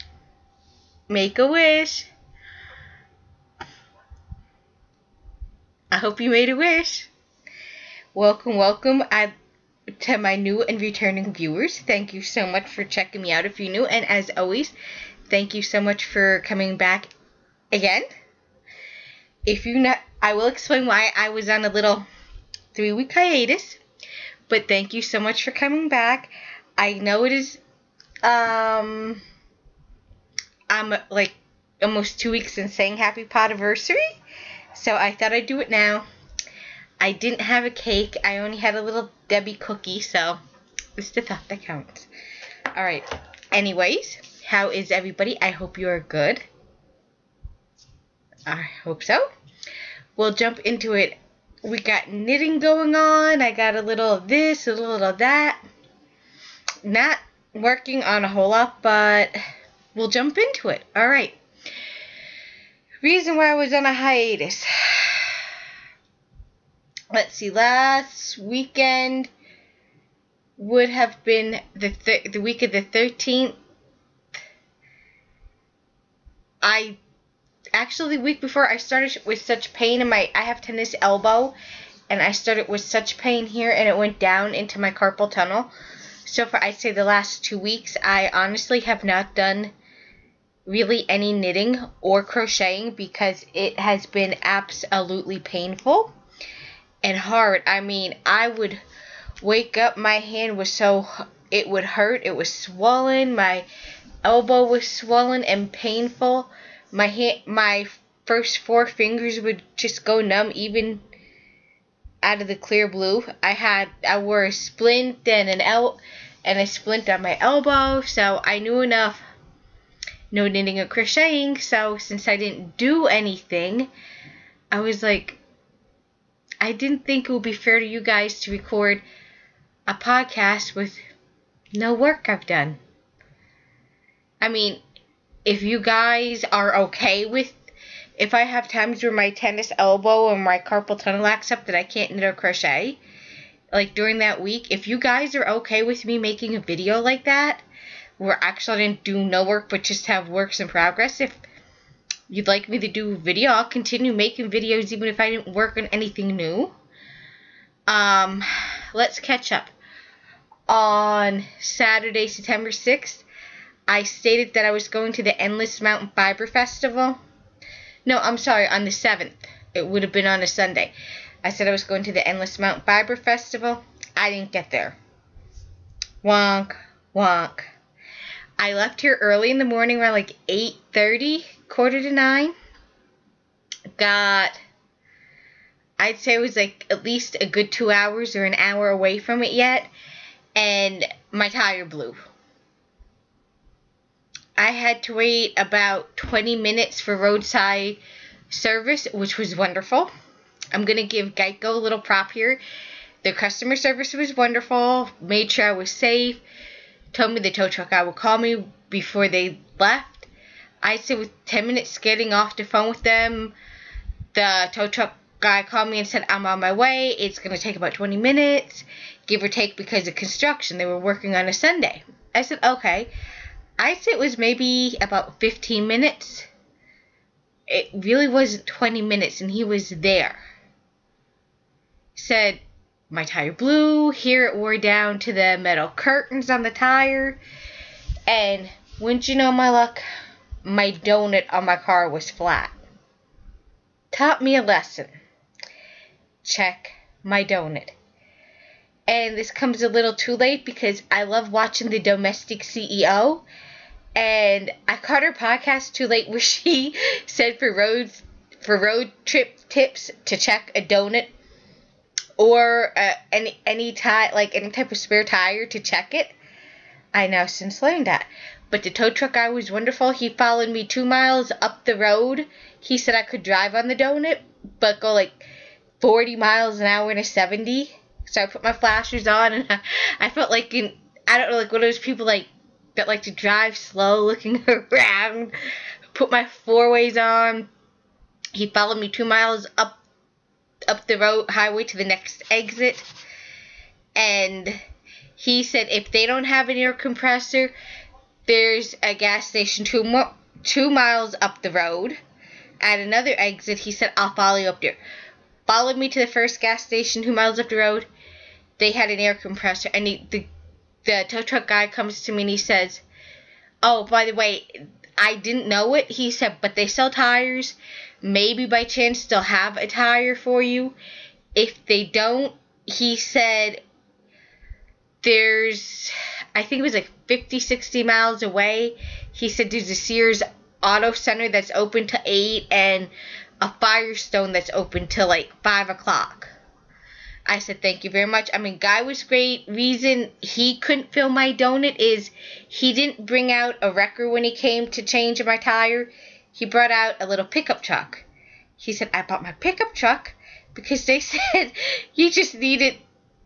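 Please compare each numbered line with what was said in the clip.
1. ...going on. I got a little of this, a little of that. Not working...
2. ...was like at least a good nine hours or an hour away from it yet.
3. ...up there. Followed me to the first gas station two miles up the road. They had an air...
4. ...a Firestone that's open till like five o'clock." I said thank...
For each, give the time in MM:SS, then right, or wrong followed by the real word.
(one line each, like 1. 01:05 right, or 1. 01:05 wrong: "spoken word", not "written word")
1. 00:52 right
2. 03:06 wrong: "two", not "nine"
3. 05:04 right
4. 05:33 right.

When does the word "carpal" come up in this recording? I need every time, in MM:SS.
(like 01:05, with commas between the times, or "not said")
01:24, 02:20.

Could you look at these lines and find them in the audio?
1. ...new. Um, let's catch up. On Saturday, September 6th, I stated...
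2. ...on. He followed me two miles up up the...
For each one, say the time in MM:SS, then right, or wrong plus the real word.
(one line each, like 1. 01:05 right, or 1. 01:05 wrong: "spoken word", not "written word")
1. 02:36 right
2. 04:47 right.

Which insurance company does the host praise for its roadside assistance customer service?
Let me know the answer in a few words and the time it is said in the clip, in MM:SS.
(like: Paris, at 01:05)
Geico, at 03:21.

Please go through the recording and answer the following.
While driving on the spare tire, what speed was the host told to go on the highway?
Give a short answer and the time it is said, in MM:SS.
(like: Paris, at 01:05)
40 miles an hour, at 04:36.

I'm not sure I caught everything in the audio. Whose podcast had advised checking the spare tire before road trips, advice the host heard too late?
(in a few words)
the domestic CEO.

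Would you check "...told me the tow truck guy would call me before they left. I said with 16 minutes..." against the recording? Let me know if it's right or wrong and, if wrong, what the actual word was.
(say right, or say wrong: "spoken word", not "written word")
wrong: "10", not "16".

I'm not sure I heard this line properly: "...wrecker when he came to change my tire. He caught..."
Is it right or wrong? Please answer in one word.
wrong.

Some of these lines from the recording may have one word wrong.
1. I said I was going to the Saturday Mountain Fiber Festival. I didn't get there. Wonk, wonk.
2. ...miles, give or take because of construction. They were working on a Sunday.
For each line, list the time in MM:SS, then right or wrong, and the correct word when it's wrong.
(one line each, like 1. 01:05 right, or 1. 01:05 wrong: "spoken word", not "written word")
1. 02:51 wrong: "Endless", not "Saturday"
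2. 03:38 wrong: "minutes", not "miles".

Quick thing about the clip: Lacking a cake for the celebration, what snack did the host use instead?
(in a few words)
Little Debbie cookie.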